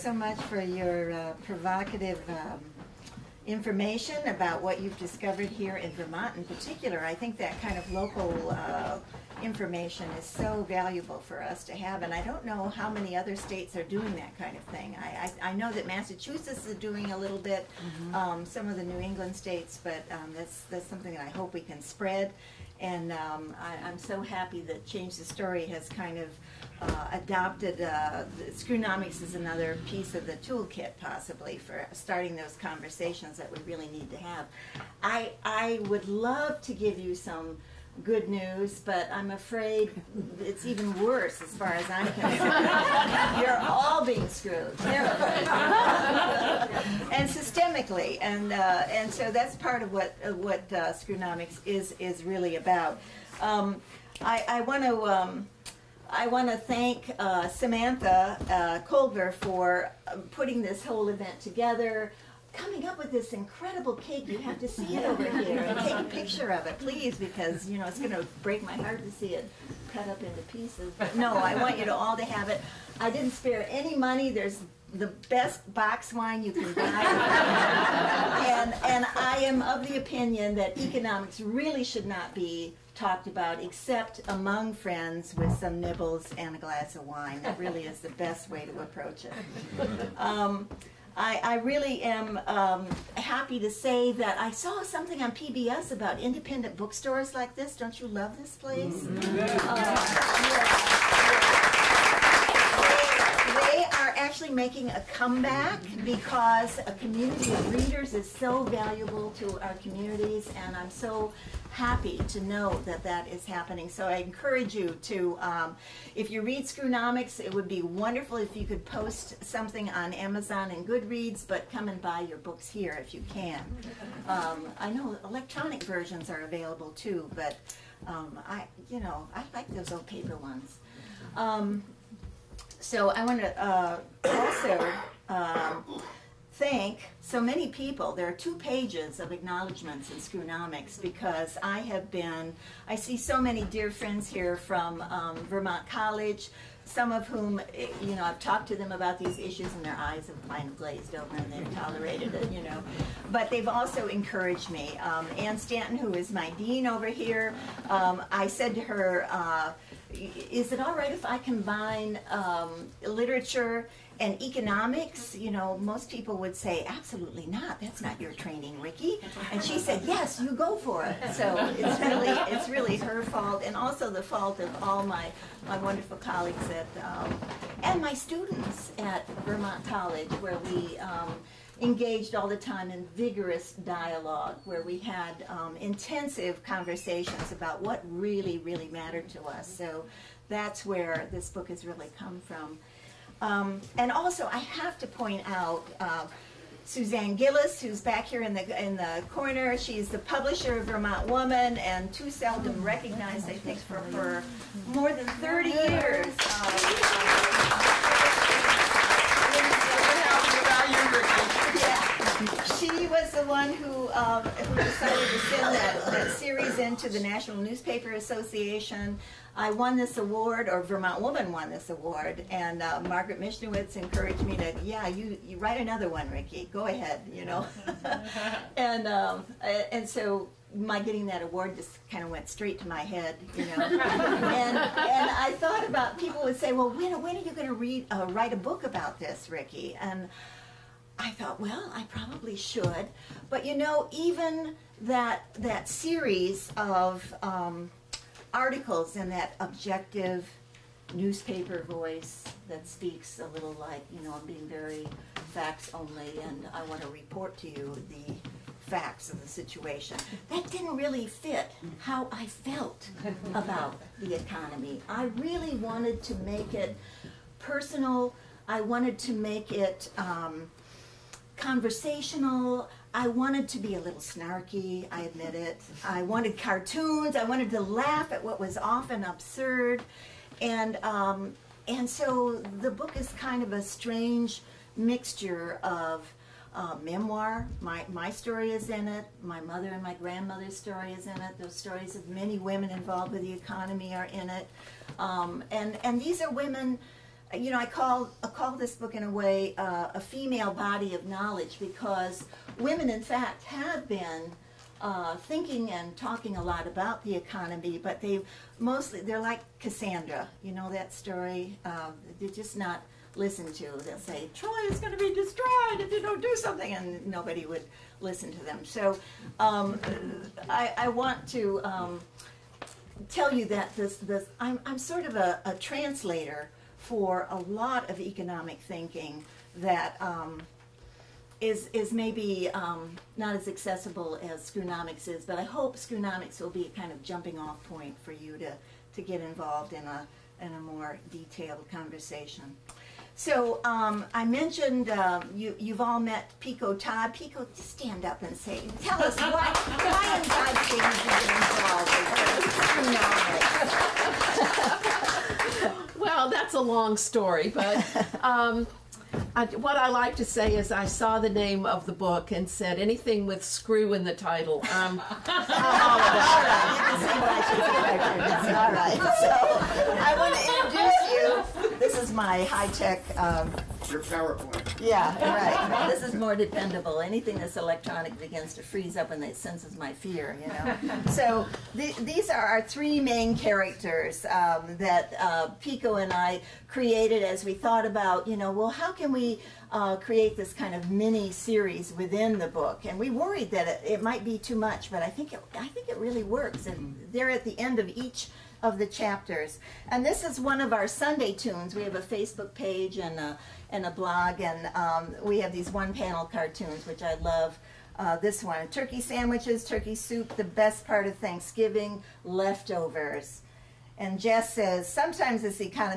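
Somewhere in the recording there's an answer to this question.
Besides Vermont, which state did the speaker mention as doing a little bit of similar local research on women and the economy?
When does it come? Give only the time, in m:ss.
0:15.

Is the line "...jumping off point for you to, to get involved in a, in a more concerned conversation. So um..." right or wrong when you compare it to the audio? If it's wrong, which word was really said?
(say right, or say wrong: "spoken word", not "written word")
wrong: "detailed", not "concerned".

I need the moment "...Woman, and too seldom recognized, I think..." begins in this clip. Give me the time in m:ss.
3:21.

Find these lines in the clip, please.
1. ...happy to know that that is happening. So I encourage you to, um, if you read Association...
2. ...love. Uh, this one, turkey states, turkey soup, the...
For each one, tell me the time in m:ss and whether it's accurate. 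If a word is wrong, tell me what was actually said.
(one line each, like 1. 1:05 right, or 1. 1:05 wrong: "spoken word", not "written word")
1. 1:51 wrong: "Screwnomics", not "Association"
2. 6:47 wrong: "sandwiches", not "states".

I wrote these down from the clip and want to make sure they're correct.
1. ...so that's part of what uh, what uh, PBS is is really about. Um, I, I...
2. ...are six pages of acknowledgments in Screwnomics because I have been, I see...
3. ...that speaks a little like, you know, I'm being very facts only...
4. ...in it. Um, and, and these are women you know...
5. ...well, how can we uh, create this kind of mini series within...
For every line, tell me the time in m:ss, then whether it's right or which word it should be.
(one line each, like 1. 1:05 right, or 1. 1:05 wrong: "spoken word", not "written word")
1. 0:49 wrong: "Screwnomics", not "PBS"
2. 2:18 wrong: "two", not "six"
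3. 4:12 right
4. 4:54 right
5. 6:28 right.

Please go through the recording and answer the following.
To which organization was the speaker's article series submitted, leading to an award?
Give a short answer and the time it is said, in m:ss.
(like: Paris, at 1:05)
National Newspaper Association, at 3:37.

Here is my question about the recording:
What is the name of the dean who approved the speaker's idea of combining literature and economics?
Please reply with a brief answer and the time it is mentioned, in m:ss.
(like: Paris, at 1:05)
Ann Stanton, at 2:35.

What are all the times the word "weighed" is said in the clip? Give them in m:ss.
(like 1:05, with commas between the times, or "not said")
not said.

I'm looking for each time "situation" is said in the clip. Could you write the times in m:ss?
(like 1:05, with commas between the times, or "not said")
4:19.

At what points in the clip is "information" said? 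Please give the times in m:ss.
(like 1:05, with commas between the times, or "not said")
0:03, 0:09.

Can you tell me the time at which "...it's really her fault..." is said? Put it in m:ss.
2:52.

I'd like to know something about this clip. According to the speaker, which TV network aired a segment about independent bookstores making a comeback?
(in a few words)
PBS.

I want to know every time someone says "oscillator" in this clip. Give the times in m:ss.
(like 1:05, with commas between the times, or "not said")
not said.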